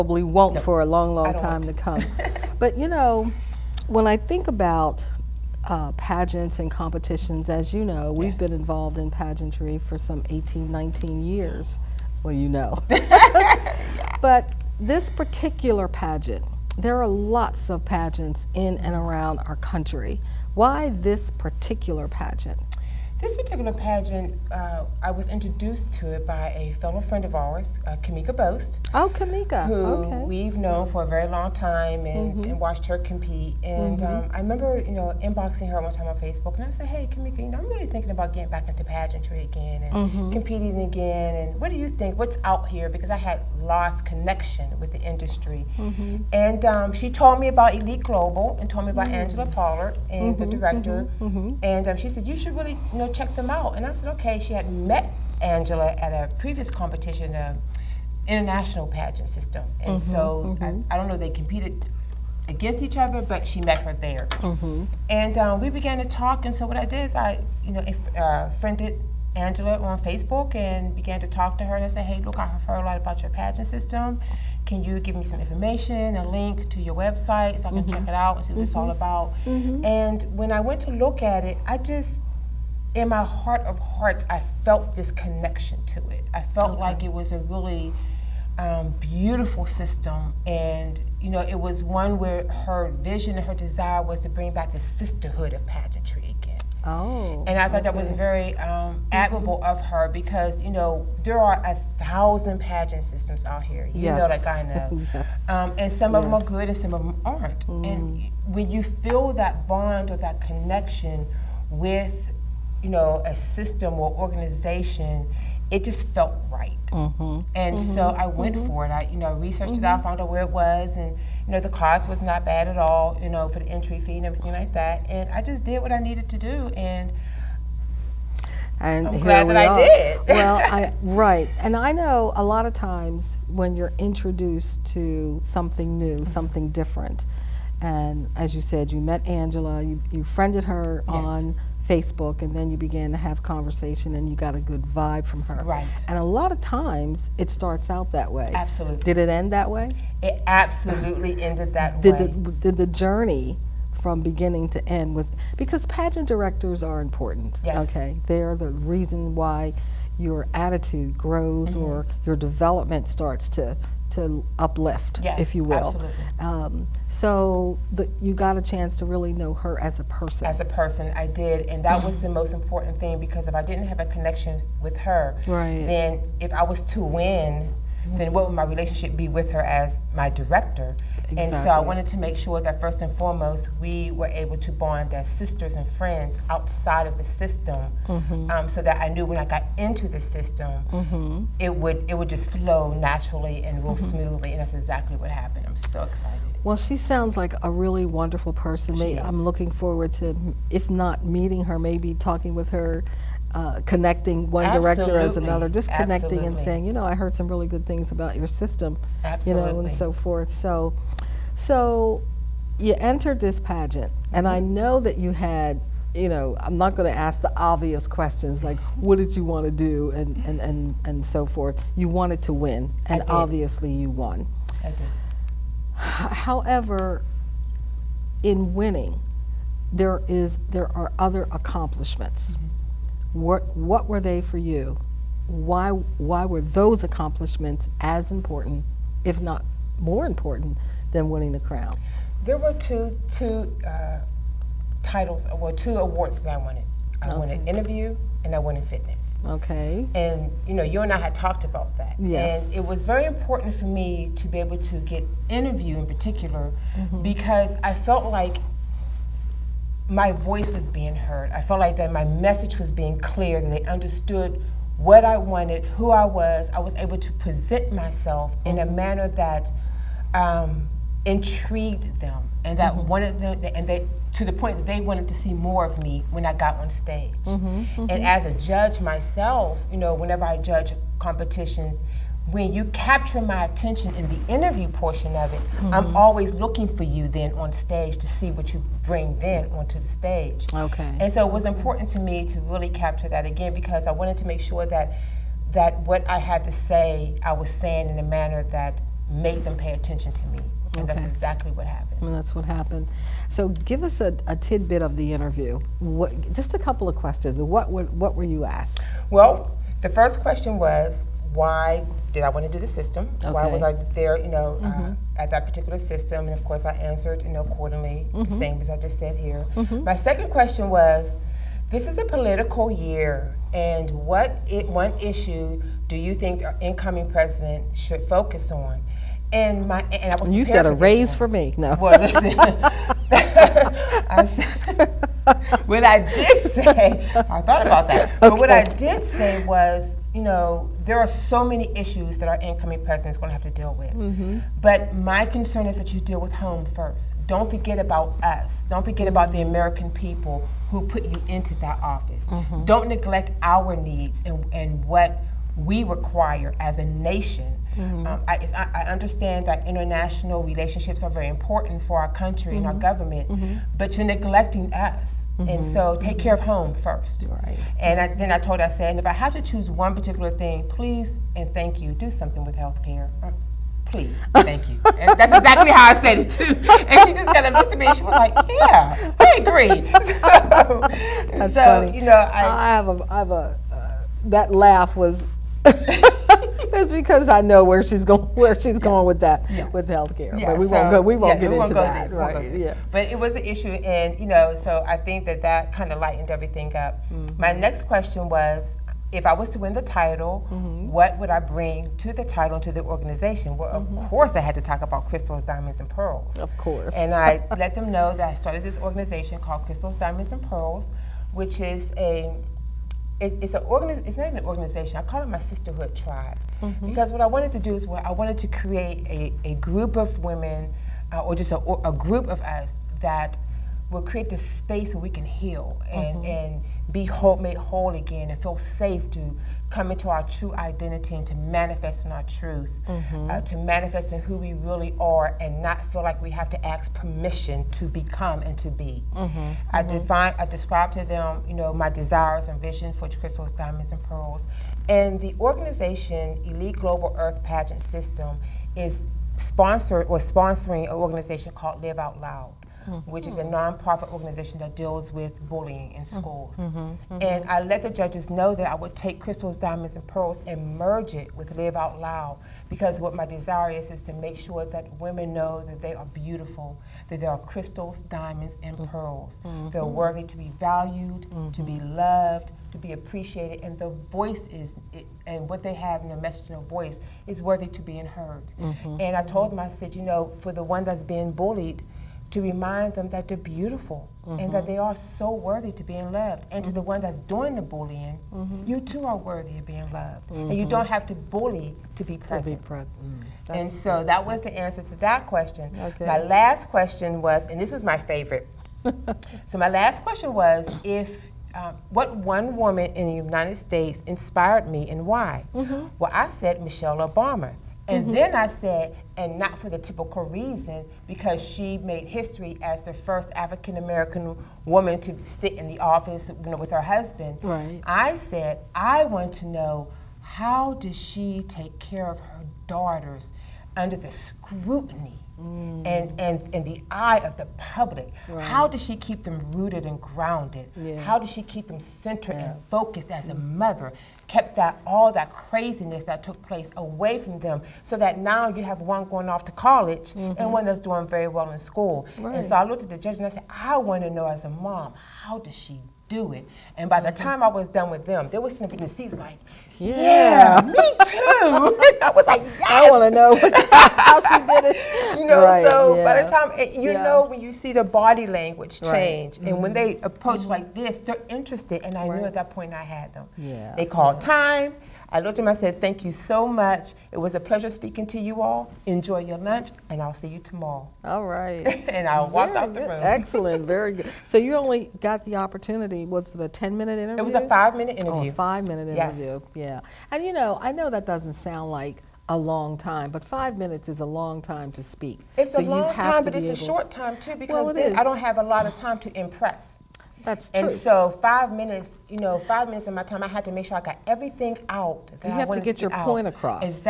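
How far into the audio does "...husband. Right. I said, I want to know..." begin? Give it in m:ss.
8:37.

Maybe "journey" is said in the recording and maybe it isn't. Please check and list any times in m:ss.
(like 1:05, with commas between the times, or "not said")
2:32.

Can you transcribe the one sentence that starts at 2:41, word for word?
or your development starts to to uplift, yes, if you will.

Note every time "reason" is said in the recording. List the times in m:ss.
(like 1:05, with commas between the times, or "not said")
2:38, 8:30.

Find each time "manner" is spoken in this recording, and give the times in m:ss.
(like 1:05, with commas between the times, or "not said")
4:28, 4:58.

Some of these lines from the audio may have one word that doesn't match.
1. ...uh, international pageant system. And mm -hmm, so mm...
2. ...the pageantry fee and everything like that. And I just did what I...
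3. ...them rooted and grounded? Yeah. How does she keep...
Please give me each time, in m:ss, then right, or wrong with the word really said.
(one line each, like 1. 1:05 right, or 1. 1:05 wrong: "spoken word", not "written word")
1. 0:57 right
2. 2:03 wrong: "entry", not "pageantry"
3. 8:49 right.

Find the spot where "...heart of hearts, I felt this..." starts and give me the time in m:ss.
1:23.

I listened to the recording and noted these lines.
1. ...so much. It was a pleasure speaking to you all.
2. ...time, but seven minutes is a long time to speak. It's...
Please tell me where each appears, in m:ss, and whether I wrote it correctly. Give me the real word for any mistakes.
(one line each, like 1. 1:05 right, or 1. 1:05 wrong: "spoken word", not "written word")
1. 9:26 right
2. 9:42 wrong: "five", not "seven".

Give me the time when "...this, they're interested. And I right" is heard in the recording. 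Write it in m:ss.
9:20.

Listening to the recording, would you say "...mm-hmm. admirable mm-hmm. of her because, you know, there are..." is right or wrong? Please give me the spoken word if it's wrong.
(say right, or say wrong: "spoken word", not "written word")
right.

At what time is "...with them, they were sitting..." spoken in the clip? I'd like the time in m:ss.
9:08.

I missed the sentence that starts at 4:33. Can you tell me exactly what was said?
wanted them, and they, to the point that they wanted to see more of me when I got on stage.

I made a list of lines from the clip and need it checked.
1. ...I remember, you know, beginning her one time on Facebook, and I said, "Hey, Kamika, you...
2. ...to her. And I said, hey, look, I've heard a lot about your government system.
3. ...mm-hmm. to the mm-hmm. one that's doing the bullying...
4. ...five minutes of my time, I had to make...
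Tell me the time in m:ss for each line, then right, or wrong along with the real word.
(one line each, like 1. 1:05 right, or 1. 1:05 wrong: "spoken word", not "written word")
1. 0:34 wrong: "inboxing", not "beginning"
2. 1:11 wrong: "pageant", not "government"
3. 8:06 right
4. 9:52 right.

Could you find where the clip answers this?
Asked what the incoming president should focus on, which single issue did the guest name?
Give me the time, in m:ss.
6:12.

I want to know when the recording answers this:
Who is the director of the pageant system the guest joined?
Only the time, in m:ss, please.
0:49.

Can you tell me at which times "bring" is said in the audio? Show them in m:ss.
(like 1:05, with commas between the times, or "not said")
1:34, 4:49, 6:41.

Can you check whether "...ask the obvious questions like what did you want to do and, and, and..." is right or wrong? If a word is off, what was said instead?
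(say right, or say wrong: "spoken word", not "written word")
right.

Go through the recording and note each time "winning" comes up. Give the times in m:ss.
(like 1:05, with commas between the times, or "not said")
3:48, 4:01.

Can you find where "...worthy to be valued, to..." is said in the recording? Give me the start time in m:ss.
7:50.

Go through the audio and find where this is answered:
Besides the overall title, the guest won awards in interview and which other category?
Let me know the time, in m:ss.
4:08.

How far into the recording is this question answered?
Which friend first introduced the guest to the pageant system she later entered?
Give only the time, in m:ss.
0:27.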